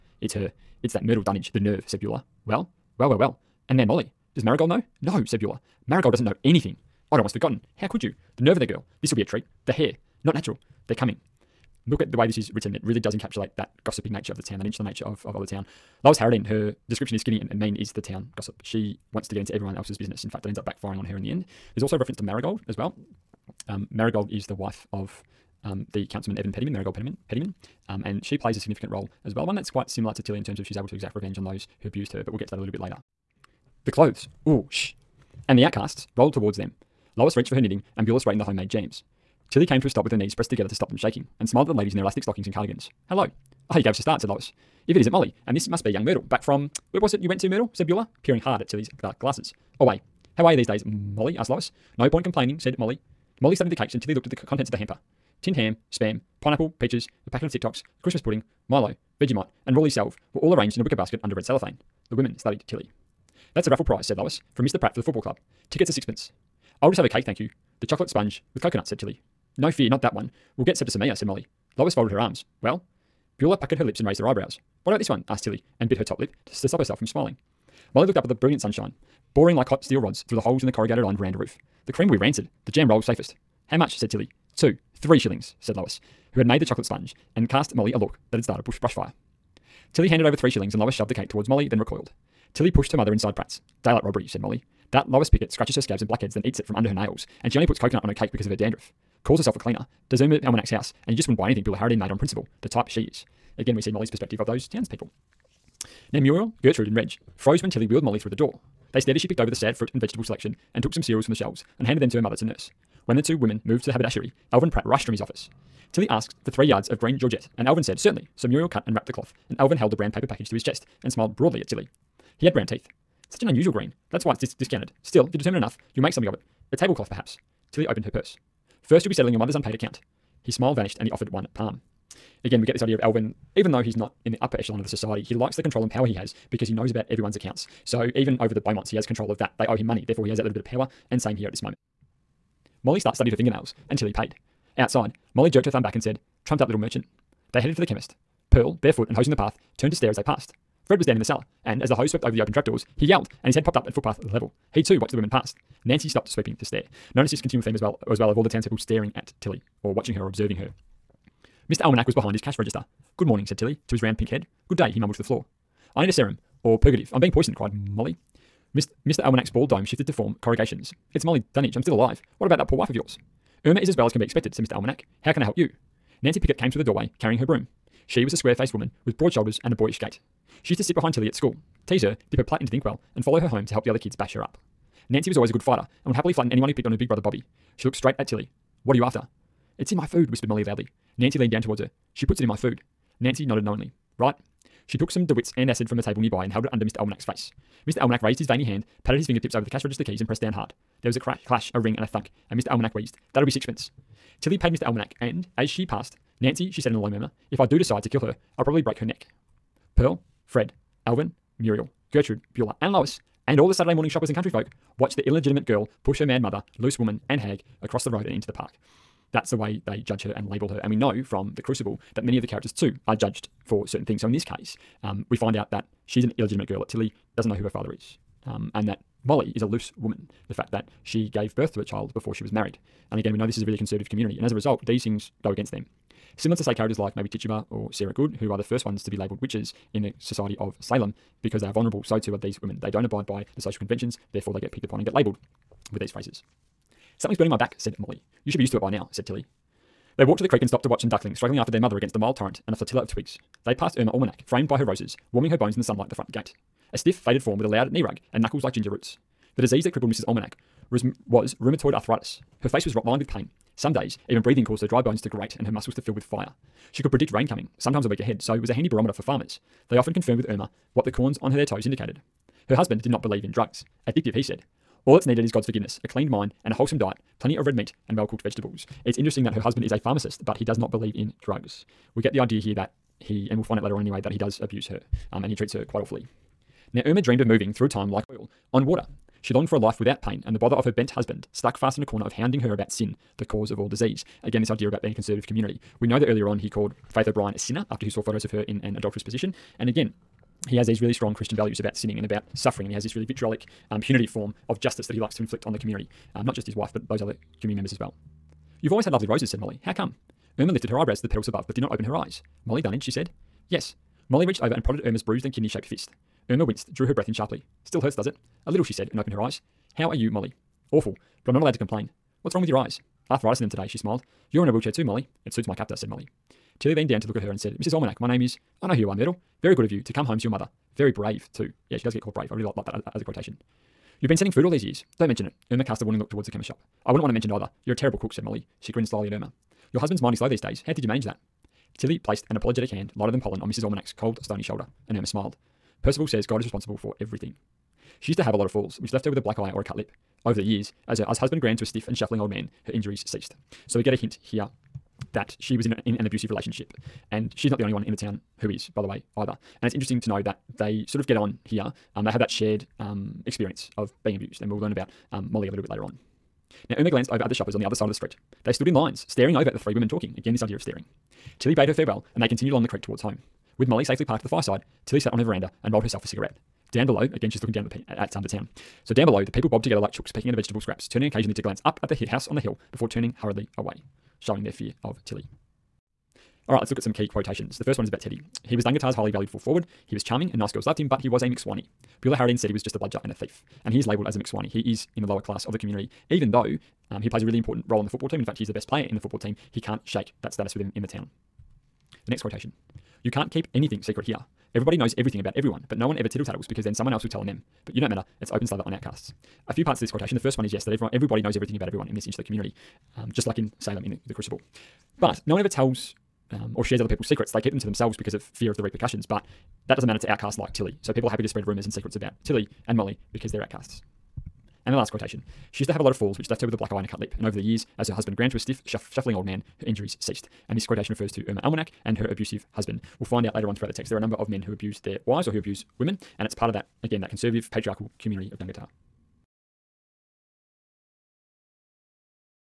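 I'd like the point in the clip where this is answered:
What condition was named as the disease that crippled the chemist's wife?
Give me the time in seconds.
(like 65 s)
261 s.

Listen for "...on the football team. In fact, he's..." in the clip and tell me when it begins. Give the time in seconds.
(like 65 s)
397 s.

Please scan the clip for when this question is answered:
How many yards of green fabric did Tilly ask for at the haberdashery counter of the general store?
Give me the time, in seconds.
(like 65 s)
116 s.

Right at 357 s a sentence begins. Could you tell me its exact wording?
And she's not the only one in the town who is, by the way, either.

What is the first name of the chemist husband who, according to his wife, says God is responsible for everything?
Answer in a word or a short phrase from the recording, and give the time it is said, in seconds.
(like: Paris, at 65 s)
Percival, at 346 s.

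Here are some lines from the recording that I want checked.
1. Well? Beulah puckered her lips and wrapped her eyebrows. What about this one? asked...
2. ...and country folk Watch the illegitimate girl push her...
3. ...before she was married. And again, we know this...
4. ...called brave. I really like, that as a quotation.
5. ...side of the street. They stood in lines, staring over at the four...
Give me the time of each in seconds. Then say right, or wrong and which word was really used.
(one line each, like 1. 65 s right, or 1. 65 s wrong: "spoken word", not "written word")
1. 72 s wrong: "raised", not "wrapped"
2. 214 s right
3. 232 s right
4. 332 s right
5. 367 s wrong: "three", not "four".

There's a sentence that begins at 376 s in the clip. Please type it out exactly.
Down below, again, she's looking down at the at um, the town.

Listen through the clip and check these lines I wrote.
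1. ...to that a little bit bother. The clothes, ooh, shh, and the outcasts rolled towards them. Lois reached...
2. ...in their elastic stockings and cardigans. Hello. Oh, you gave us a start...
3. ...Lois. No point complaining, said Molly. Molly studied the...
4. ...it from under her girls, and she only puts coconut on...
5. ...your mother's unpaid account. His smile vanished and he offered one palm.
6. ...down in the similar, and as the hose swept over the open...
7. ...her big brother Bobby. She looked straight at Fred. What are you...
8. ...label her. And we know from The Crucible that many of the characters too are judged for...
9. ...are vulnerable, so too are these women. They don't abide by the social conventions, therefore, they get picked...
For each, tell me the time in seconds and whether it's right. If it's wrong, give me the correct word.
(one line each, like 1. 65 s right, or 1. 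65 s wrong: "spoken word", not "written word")
1. 32 s wrong: "later", not "bother"
2. 41 s right
3. 51 s right
4. 96 s wrong: "nails", not "girls"
5. 129 s right
6. 151 s wrong: "cellar", not "similar"
7. 186 s wrong: "Tilly", not "Fred"
8. 220 s right
9. 241 s right.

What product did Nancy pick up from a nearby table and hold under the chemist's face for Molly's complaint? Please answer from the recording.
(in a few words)
De Witt's antacid.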